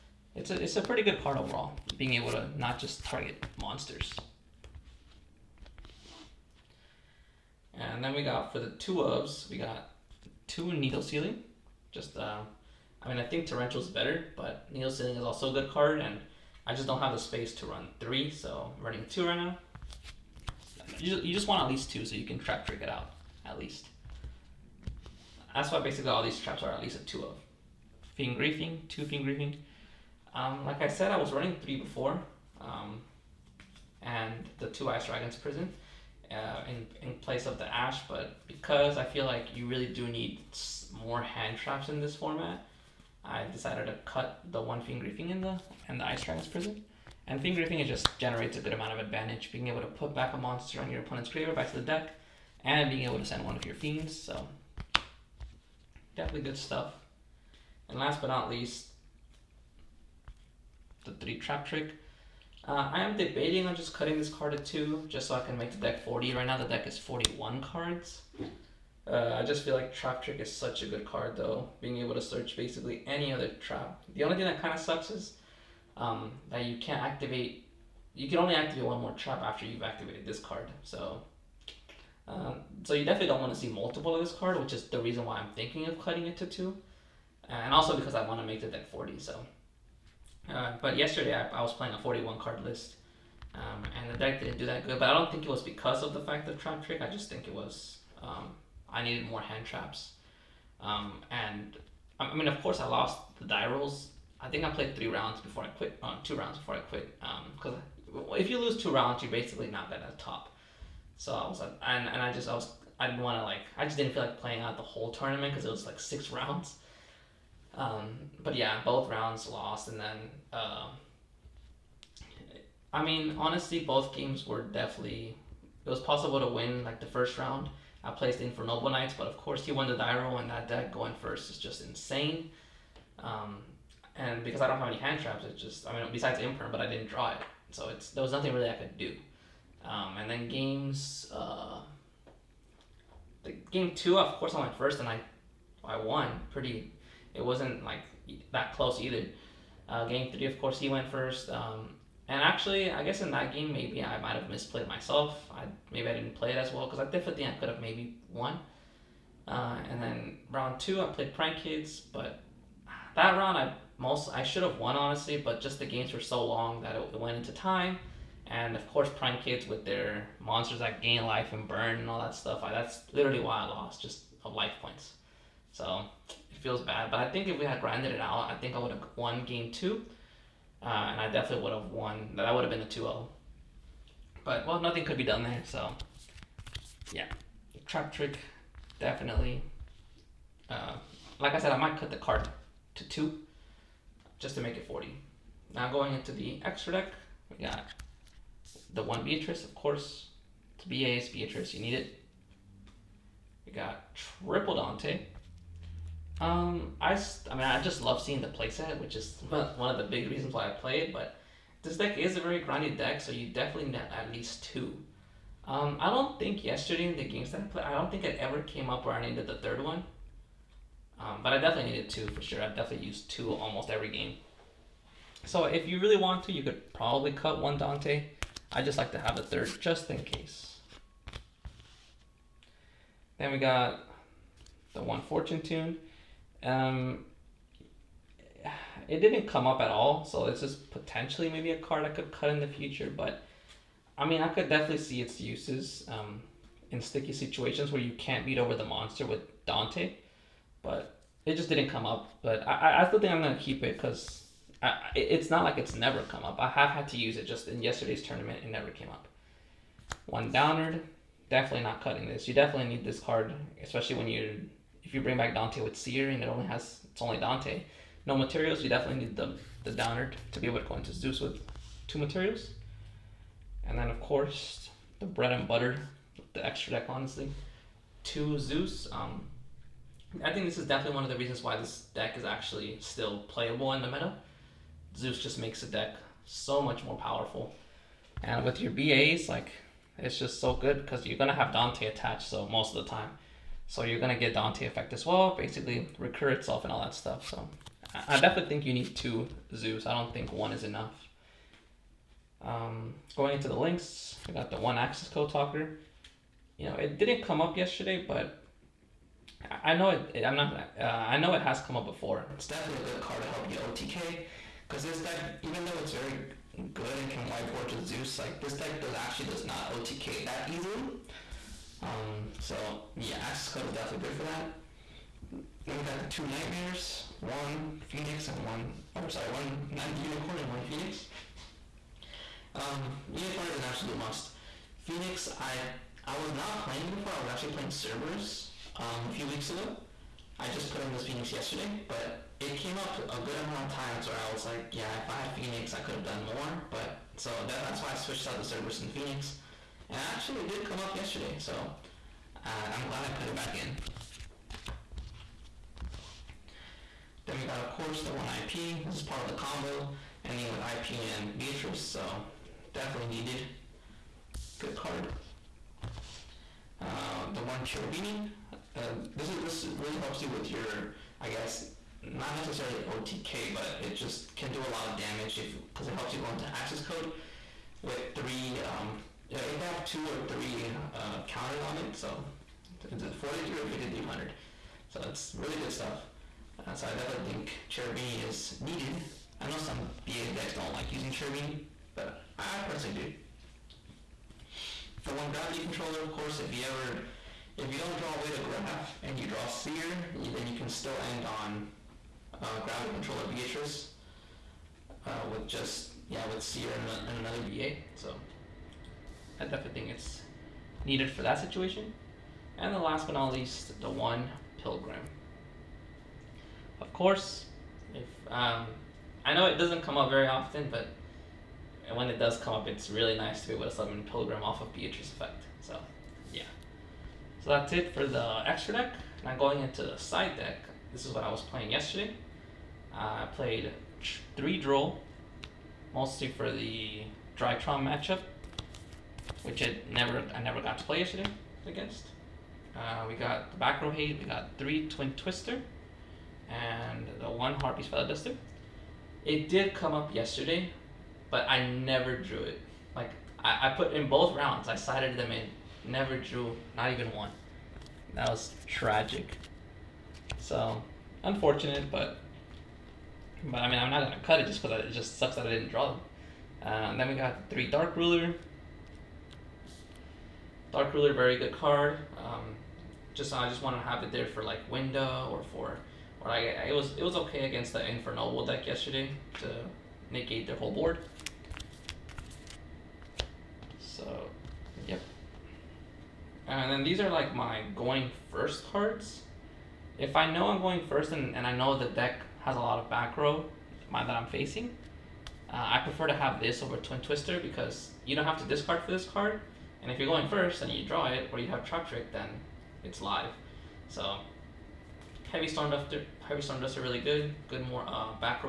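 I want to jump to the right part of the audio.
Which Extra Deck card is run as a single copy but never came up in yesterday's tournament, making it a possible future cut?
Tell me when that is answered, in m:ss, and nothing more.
3:55.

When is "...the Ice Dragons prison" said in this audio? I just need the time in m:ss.
0:45.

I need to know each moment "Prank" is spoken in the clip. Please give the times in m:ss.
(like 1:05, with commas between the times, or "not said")
2:41, 2:49.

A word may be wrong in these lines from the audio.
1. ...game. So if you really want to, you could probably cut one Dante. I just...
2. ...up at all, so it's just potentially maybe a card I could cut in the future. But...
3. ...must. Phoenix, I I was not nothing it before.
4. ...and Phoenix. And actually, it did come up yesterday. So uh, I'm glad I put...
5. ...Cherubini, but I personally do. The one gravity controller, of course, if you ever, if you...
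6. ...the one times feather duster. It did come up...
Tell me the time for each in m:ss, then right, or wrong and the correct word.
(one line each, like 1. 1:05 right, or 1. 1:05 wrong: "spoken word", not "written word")
1. 3:44 right
2. 3:59 right
3. 5:34 wrong: "playing", not "nothing"
4. 5:49 right
5. 6:31 right
6. 7:27 wrong: "harpies", not "times".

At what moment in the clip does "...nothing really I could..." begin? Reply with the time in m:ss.
2:18.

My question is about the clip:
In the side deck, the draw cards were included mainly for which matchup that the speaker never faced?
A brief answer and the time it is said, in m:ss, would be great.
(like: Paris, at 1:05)
Drytron, at 7:17.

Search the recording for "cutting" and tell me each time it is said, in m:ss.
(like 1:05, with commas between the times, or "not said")
1:03, 1:25, 4:22.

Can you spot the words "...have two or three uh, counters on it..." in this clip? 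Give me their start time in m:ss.
6:19.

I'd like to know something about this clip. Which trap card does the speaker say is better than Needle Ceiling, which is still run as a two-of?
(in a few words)
Torrential.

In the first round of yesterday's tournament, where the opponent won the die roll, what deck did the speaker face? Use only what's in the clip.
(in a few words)
Noble Knights.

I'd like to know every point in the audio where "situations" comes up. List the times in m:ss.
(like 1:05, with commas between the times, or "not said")
4:07, 6:51.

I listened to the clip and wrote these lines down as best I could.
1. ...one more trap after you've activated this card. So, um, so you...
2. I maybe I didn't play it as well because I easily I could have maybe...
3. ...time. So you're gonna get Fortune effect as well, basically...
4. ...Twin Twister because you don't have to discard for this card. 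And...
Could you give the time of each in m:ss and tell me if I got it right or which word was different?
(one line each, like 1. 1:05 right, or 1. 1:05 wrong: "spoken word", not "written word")
1. 1:18 right
2. 2:35 wrong: "definitely", not "easily"
3. 4:53 wrong: "Dante", not "Fortune"
4. 8:16 right.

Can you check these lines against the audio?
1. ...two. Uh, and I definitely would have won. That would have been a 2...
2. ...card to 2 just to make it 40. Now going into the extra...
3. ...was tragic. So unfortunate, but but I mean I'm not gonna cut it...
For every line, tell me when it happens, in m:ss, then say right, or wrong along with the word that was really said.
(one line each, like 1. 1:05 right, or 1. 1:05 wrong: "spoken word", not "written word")
1. 2:59 right
2. 3:12 right
3. 7:38 right.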